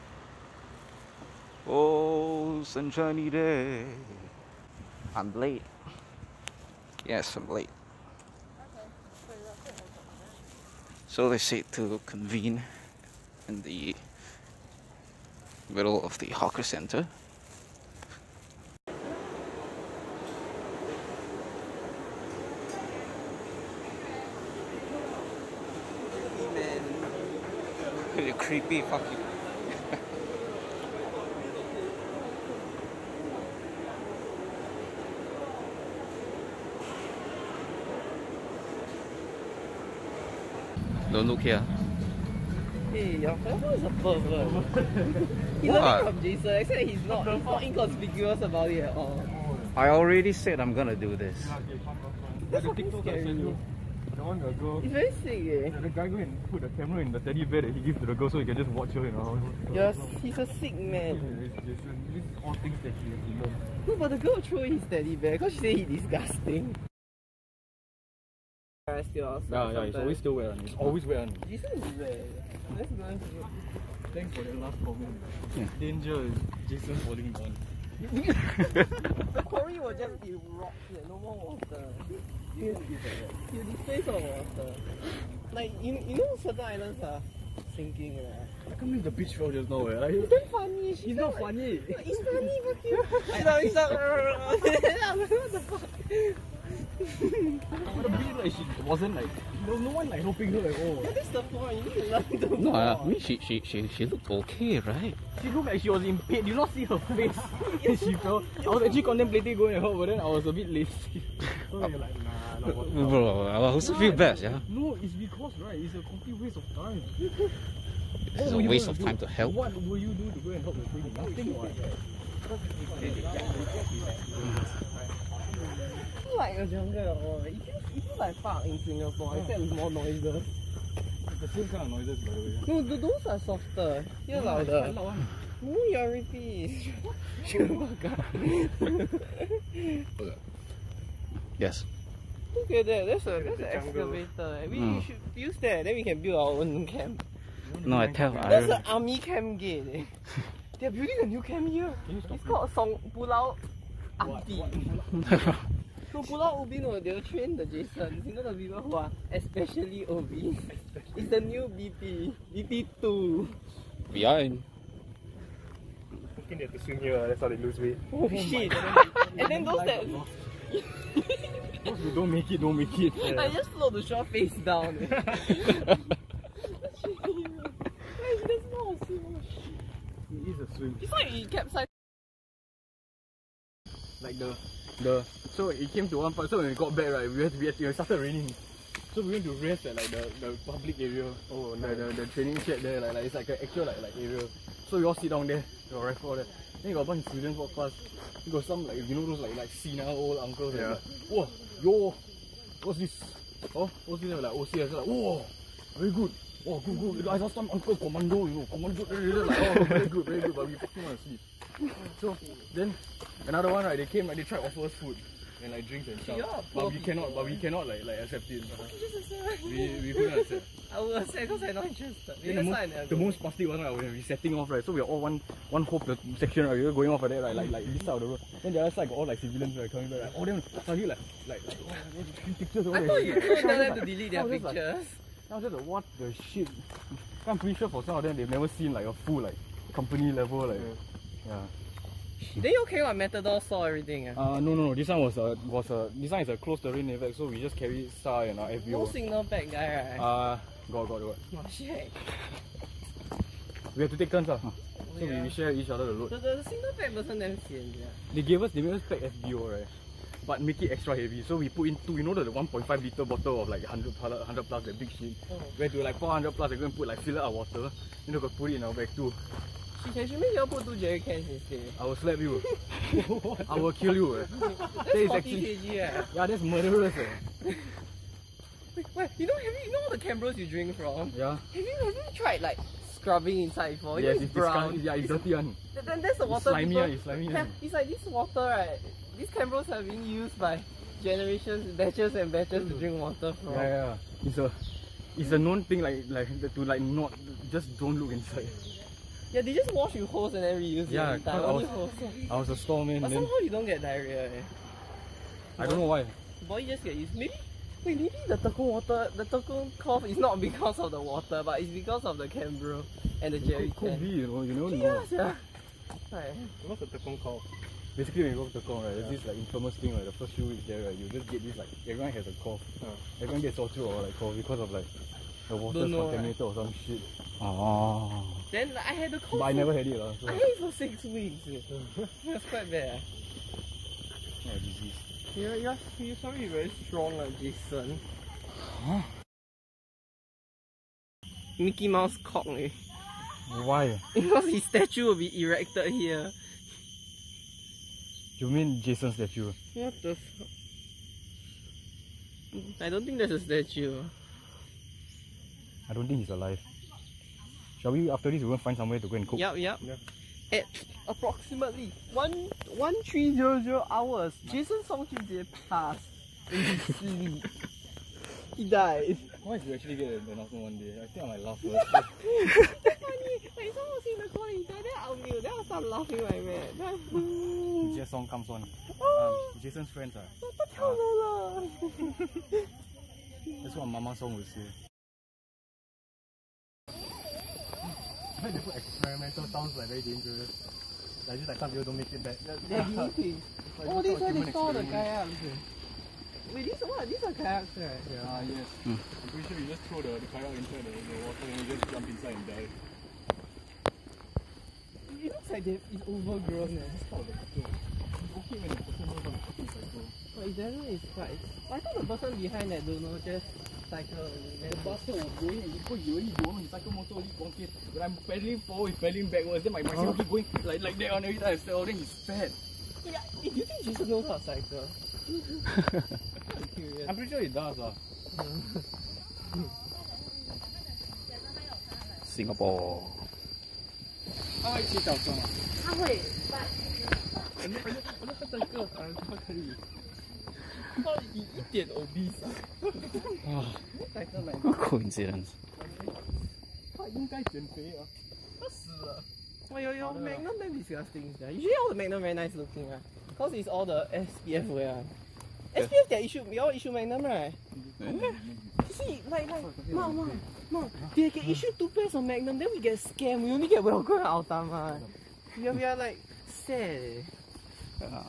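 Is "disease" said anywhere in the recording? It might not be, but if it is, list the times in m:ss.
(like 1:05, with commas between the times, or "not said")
5:34.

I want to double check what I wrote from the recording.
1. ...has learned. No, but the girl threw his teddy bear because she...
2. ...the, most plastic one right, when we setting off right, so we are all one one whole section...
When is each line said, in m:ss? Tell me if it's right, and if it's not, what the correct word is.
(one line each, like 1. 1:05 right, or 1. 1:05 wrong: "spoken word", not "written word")
1. 1:03 right
2. 3:43 right.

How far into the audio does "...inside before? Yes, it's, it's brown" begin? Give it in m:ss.
4:43.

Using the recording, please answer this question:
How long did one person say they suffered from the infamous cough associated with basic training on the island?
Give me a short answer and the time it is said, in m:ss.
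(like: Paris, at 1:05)
Six weeks, at 5:30.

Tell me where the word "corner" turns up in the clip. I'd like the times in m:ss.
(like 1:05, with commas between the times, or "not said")
6:14.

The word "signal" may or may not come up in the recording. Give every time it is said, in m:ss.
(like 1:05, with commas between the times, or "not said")
4:09, 4:16.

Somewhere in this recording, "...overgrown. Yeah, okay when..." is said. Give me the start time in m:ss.
6:46.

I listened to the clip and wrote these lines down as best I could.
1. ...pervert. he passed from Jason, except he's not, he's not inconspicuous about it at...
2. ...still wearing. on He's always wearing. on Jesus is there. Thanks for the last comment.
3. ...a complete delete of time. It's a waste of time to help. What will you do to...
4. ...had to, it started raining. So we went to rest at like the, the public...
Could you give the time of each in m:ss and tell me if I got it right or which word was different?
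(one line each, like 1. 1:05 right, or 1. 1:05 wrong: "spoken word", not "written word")
1. 0:44 wrong: "learned", not "passed"
2. 1:10 right
3. 1:55 wrong: "waste", not "delete"
4. 3:07 right.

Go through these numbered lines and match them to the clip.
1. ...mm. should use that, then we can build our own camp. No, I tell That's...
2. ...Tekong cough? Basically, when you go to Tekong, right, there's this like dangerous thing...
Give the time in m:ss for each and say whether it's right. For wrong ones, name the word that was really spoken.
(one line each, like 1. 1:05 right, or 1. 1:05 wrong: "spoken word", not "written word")
1. 2:24 right
2. 5:17 wrong: "infamous", not "dangerous".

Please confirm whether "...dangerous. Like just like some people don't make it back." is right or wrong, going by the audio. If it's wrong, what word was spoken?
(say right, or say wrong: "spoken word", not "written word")
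right.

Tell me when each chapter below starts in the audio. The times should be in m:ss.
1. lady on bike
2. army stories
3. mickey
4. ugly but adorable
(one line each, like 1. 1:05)
1. 1:06
2. 3:02
3. 5:40
4. 6:25.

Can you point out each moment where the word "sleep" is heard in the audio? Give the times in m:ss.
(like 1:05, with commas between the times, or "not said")
3:31, 6:07.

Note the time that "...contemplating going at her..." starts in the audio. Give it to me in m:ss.
1:49.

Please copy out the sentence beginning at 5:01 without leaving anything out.
Yeah, I was, a I was a stormman.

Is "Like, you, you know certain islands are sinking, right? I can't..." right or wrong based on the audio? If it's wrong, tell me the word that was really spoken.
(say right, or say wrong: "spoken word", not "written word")
right.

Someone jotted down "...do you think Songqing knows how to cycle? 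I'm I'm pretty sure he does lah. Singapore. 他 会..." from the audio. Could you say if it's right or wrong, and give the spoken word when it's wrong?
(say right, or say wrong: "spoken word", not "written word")
wrong: "Jesus", not "Songqing".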